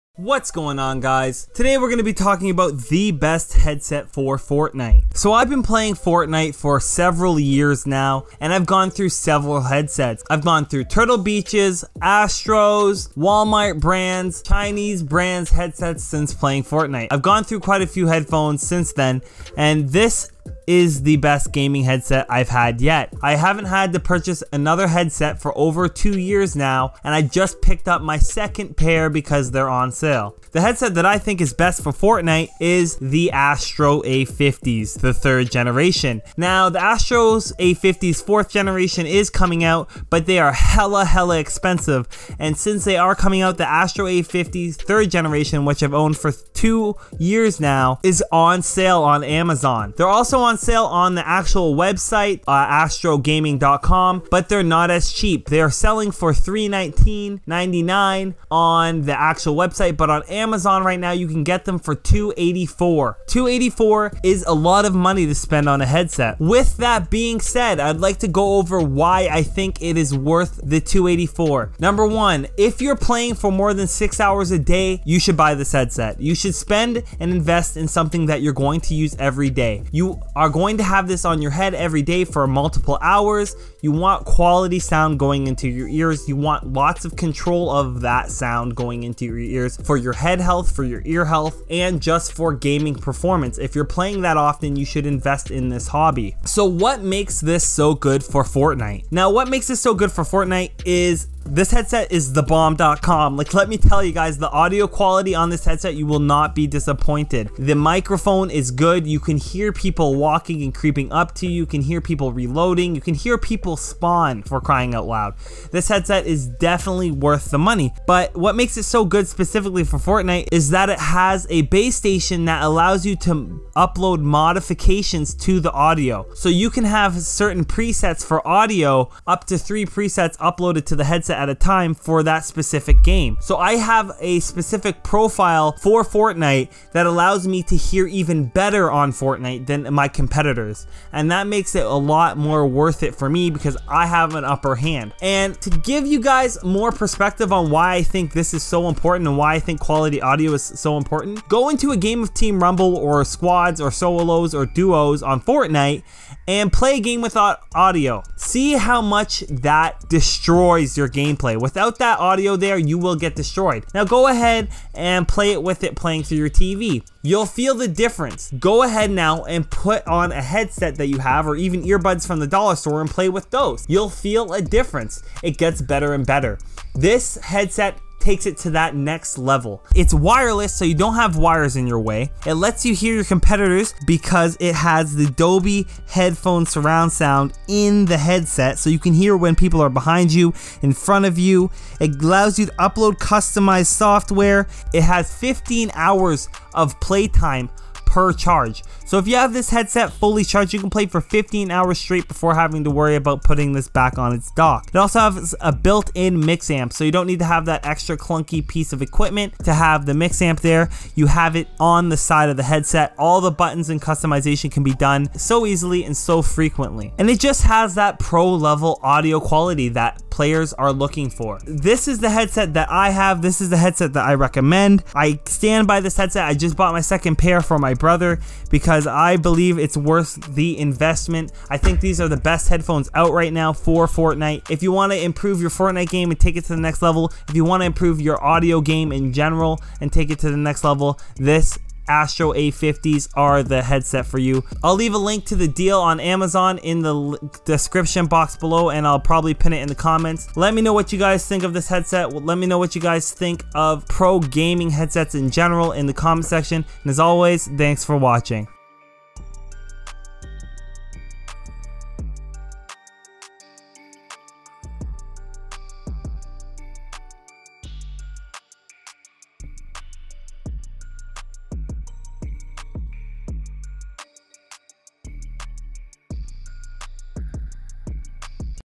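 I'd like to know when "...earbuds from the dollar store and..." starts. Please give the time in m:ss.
2:51.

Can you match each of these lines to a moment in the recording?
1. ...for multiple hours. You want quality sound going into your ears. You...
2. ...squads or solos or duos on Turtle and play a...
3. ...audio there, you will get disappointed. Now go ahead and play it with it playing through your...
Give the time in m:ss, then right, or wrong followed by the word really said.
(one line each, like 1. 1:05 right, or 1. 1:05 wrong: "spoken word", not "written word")
1. 1:22 right
2. 2:33 wrong: "Fortnite", not "Turtle"
3. 2:42 wrong: "destroyed", not "disappointed".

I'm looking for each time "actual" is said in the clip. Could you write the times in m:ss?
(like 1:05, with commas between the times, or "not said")
0:51, 0:59.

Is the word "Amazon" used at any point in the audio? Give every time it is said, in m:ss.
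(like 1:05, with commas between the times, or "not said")
0:49, 1:00, 4:06.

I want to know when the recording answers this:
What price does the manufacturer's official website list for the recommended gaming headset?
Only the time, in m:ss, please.
0:56.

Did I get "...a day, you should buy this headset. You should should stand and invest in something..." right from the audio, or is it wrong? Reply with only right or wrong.
wrong.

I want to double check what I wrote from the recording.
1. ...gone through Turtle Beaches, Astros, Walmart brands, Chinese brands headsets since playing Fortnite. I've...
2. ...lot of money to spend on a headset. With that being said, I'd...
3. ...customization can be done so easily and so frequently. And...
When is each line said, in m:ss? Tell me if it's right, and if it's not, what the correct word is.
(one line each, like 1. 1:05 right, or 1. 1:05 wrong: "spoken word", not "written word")
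1. 0:10 right
2. 1:04 right
3. 3:34 right.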